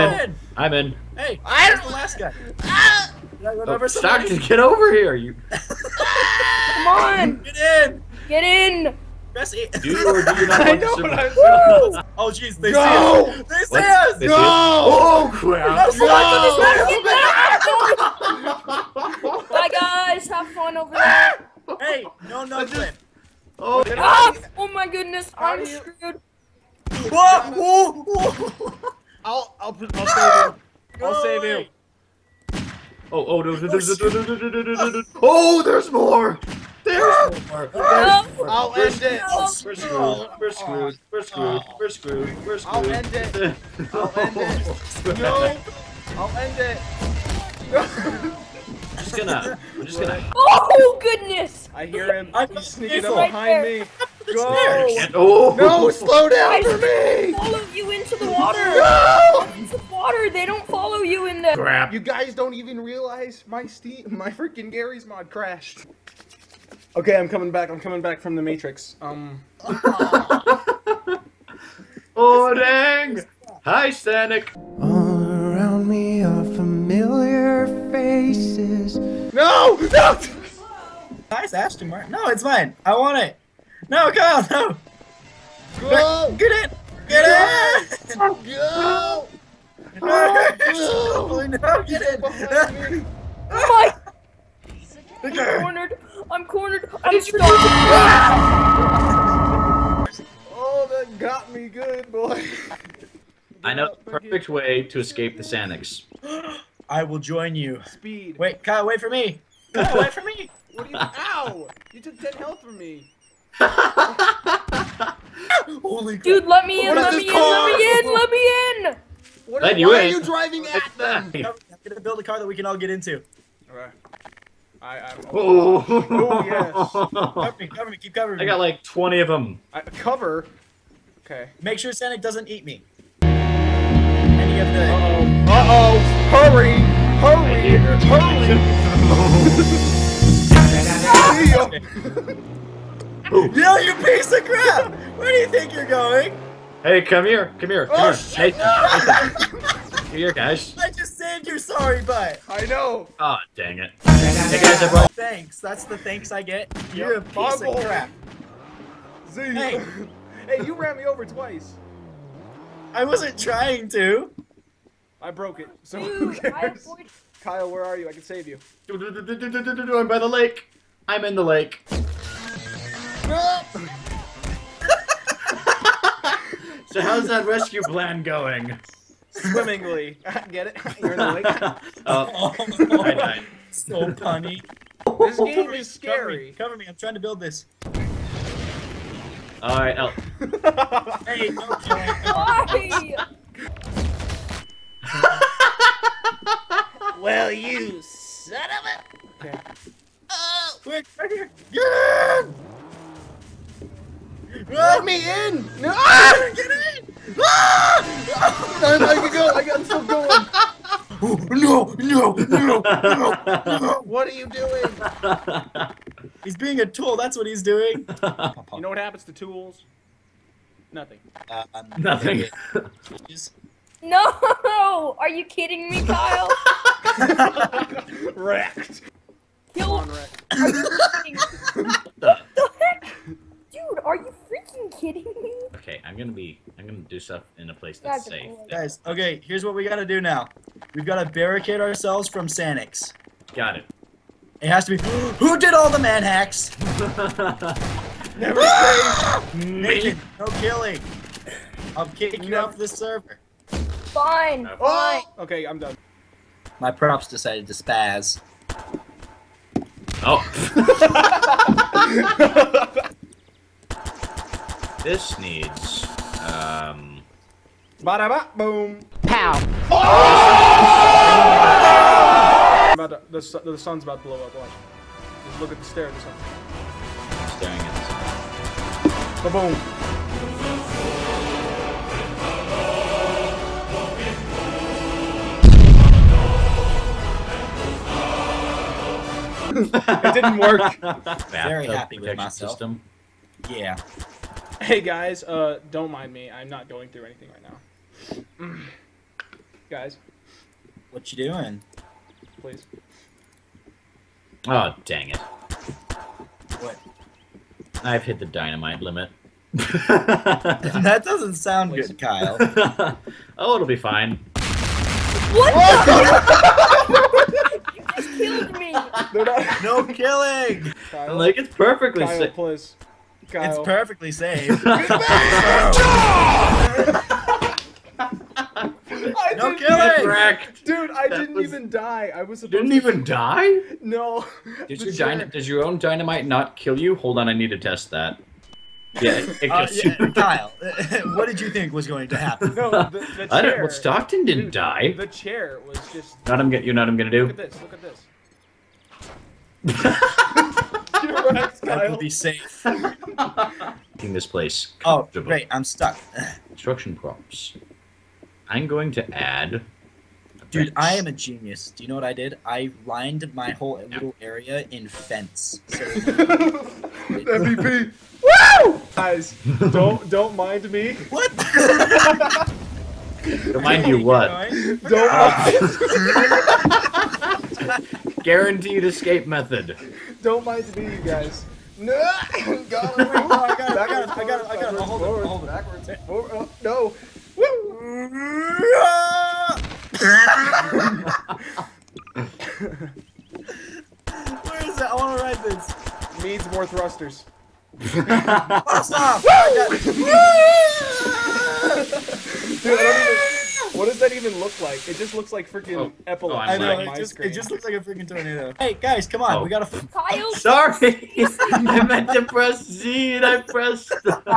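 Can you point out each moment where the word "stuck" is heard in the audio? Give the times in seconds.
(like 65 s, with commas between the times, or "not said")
97 s, 355 s.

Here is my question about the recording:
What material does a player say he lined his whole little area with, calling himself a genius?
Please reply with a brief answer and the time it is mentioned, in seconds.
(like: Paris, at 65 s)
fence, at 365 s.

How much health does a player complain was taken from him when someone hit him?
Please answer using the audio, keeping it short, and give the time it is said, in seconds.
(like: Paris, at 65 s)
10, at 112 s.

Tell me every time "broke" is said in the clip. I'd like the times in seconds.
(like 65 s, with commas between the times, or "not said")
165 s.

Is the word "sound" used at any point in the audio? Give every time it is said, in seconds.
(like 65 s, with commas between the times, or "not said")
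311 s.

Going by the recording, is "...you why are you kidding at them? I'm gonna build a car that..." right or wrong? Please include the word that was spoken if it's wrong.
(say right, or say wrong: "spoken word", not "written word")
wrong: "driving", not "kidding".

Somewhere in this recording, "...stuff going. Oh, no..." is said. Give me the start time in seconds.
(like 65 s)
209 s.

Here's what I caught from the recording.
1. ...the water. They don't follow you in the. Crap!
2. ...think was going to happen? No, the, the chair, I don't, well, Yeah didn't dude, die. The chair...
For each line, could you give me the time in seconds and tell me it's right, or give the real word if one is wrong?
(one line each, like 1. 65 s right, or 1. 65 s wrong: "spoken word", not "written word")
1. 59 s right
2. 341 s wrong: "Stockton", not "Yeah".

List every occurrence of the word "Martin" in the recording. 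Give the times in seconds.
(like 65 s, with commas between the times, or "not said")
81 s.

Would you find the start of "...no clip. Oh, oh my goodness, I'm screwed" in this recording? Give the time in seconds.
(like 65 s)
22 s.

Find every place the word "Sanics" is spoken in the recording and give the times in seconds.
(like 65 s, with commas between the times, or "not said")
105 s, 242 s.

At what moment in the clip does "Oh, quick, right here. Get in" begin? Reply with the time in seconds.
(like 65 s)
200 s.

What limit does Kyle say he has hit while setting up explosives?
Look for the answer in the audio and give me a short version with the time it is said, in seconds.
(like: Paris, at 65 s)
dynamite limit, at 308 s.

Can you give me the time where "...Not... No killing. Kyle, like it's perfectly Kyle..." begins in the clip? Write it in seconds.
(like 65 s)
318 s.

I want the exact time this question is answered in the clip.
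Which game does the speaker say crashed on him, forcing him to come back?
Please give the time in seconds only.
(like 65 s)
64 s.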